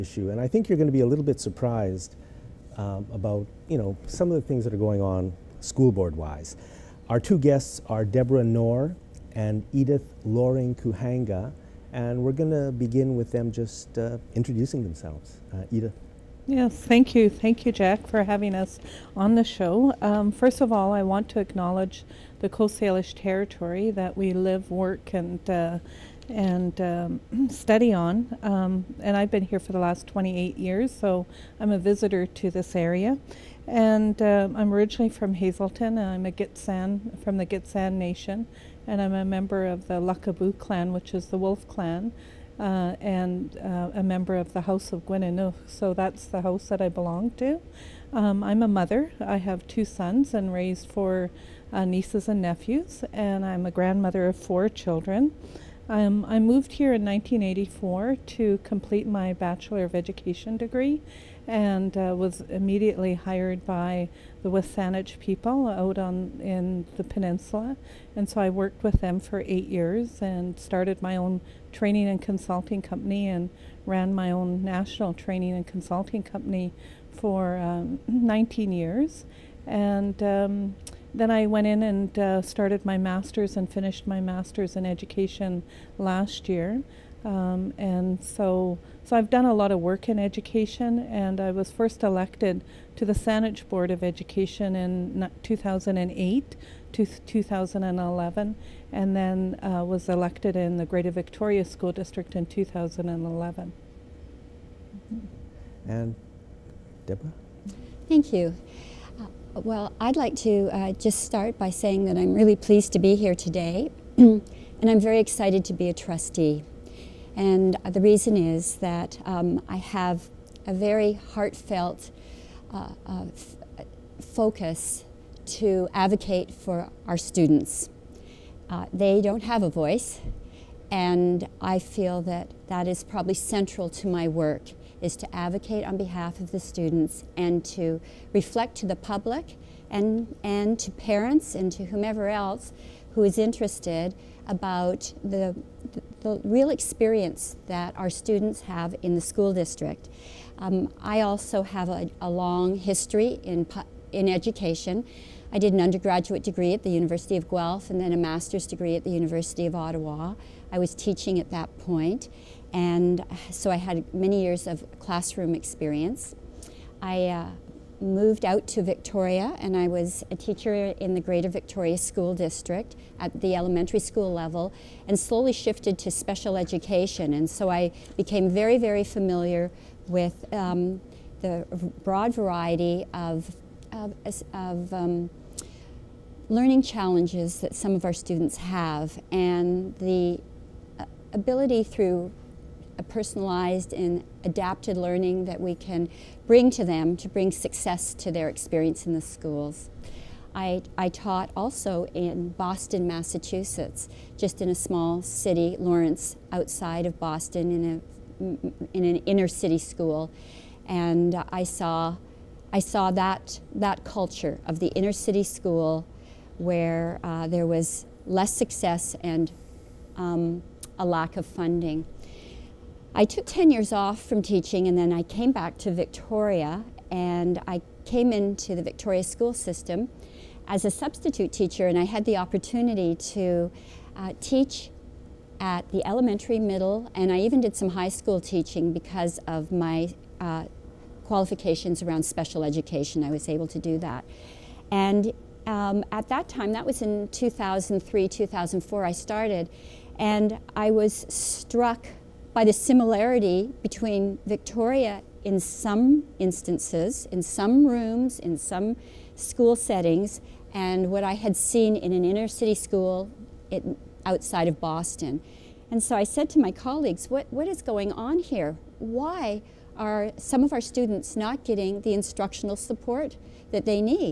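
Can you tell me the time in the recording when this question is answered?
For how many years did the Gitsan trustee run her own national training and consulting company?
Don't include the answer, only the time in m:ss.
1:18.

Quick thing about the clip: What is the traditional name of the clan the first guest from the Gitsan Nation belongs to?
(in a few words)
Lakabu.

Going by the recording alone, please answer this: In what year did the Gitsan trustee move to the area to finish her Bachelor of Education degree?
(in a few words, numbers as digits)
1984.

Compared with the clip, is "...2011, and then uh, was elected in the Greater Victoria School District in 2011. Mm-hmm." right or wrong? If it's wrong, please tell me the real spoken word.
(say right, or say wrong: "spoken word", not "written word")
right.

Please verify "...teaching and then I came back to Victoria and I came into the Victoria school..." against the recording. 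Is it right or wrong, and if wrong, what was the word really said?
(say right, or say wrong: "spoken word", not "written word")
right.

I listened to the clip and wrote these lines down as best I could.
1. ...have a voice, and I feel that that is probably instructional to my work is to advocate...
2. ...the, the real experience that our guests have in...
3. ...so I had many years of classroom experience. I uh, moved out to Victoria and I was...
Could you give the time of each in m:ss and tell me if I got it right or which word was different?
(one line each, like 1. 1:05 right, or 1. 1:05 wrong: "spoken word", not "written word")
1. 2:09 wrong: "central", not "instructional"
2. 2:25 wrong: "students", not "guests"
3. 2:43 right.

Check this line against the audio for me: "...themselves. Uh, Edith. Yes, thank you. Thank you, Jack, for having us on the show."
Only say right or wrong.
right.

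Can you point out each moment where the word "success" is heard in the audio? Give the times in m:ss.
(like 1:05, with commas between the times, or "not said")
3:17, 3:38.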